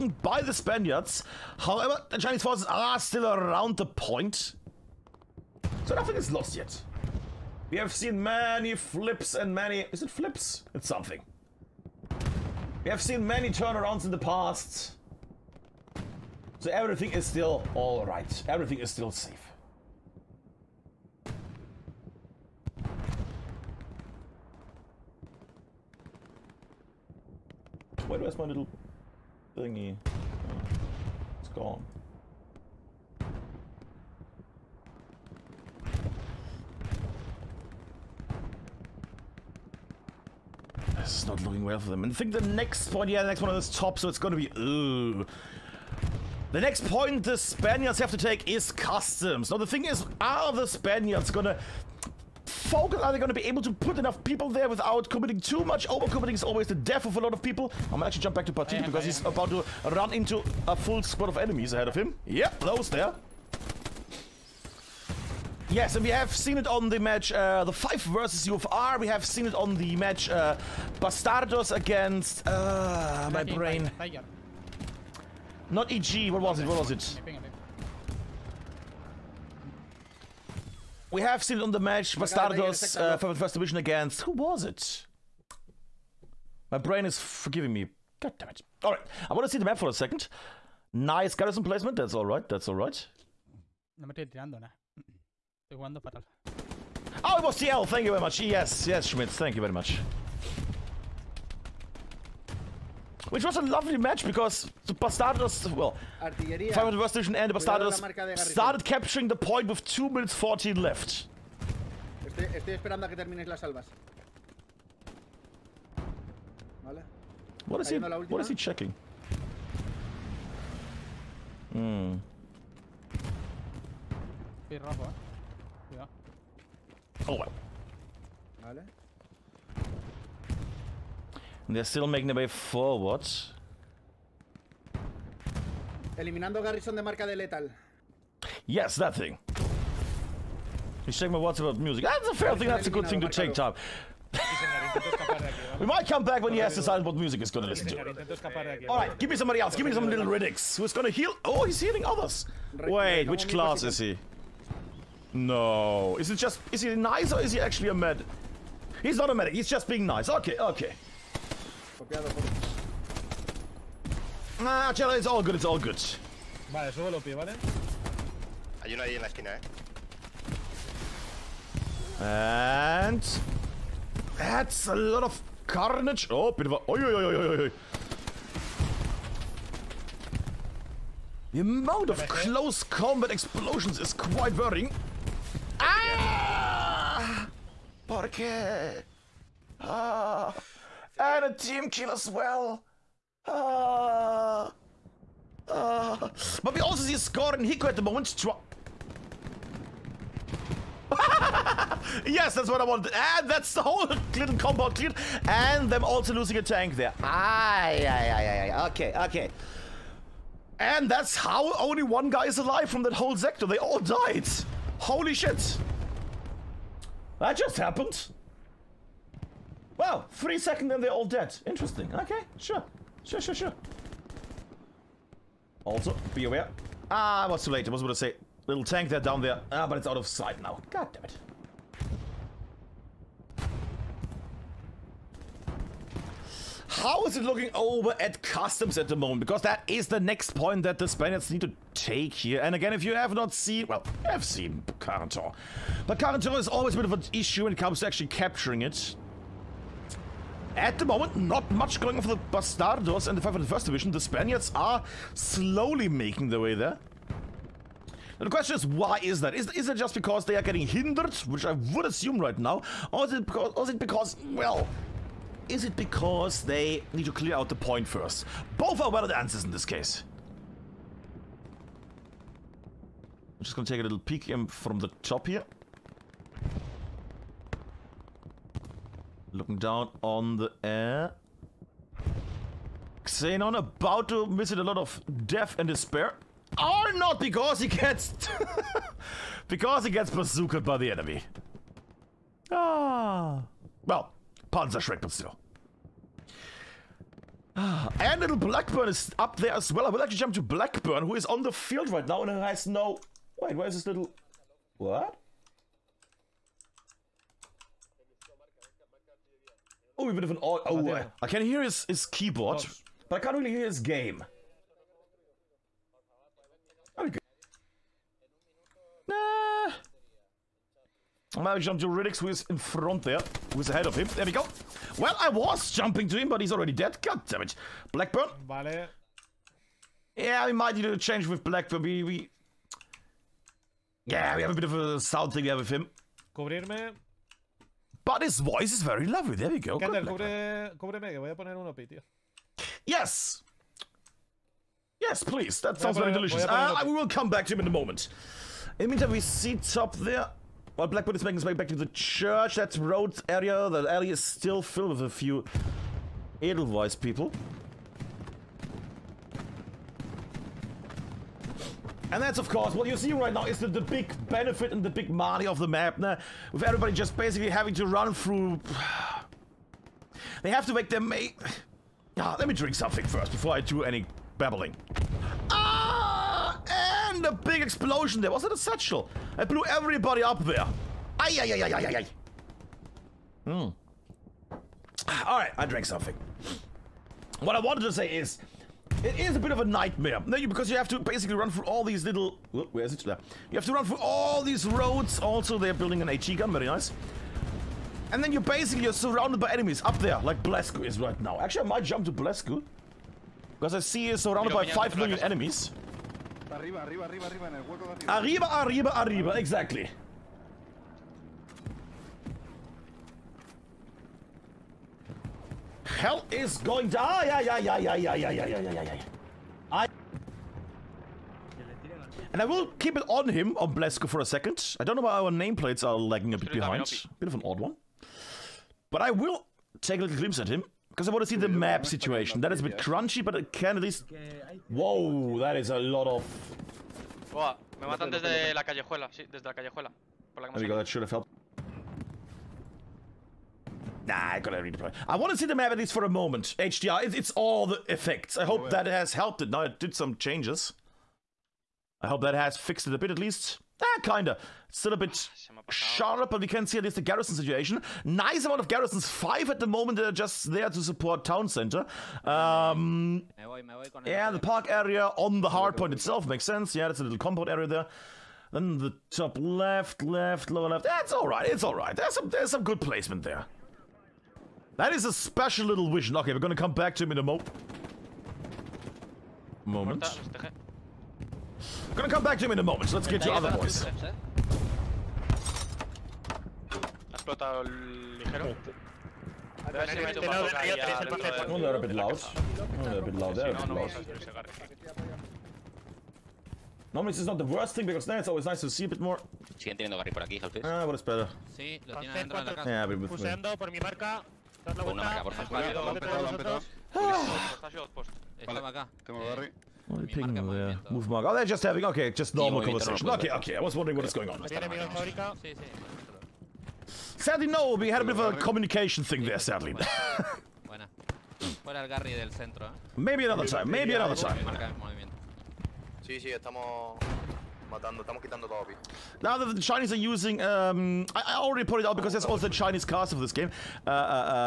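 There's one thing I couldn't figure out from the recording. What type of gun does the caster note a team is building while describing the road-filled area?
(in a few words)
HE gun.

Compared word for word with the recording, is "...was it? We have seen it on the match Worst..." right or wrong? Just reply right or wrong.
wrong.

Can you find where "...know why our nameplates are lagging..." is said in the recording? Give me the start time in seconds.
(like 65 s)
425 s.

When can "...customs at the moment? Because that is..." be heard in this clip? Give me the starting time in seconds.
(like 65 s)
238 s.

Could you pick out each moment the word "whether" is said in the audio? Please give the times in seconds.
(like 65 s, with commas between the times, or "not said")
not said.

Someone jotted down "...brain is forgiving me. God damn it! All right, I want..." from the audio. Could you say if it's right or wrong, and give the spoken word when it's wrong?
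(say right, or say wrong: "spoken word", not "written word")
right.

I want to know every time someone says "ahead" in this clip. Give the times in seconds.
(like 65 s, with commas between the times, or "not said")
61 s, 323 s.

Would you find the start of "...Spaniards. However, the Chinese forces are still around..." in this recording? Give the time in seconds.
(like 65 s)
0 s.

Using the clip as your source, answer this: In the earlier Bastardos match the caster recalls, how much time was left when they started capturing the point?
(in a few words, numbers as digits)
2 minutes 14.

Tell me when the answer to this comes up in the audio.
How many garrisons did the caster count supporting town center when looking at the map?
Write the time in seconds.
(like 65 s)
459 s.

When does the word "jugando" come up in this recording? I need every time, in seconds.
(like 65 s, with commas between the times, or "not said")
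95 s.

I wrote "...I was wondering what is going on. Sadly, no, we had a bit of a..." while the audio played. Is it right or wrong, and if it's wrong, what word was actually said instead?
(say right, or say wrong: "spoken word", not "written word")
right.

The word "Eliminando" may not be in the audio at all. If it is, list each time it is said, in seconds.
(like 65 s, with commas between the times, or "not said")
136 s.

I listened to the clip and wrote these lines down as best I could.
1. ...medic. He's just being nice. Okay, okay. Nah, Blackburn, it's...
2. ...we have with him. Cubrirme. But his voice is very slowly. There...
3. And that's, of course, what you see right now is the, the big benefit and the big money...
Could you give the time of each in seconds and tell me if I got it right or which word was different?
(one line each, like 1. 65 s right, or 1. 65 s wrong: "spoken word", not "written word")
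1. 159 s wrong: "Chela", not "Blackburn"
2. 335 s wrong: "lovely", not "slowly"
3. 362 s right.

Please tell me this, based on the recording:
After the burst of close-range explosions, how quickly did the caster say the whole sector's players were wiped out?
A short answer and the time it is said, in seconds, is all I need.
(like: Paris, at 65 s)
Three seconds, at 220 s.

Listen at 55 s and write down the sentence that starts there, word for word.
Overcommitting is always the death of a lot of people.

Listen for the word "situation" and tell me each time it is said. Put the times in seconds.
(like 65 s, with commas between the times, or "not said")
432 s, 457 s.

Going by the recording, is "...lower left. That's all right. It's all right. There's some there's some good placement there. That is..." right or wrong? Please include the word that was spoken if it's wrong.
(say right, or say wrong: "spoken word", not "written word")
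right.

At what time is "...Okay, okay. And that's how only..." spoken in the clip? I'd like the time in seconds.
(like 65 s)
208 s.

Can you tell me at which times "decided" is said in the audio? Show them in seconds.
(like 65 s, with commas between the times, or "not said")
146 s.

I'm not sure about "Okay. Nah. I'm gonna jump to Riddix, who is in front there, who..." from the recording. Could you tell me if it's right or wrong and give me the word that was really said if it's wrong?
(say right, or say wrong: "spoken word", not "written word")
right.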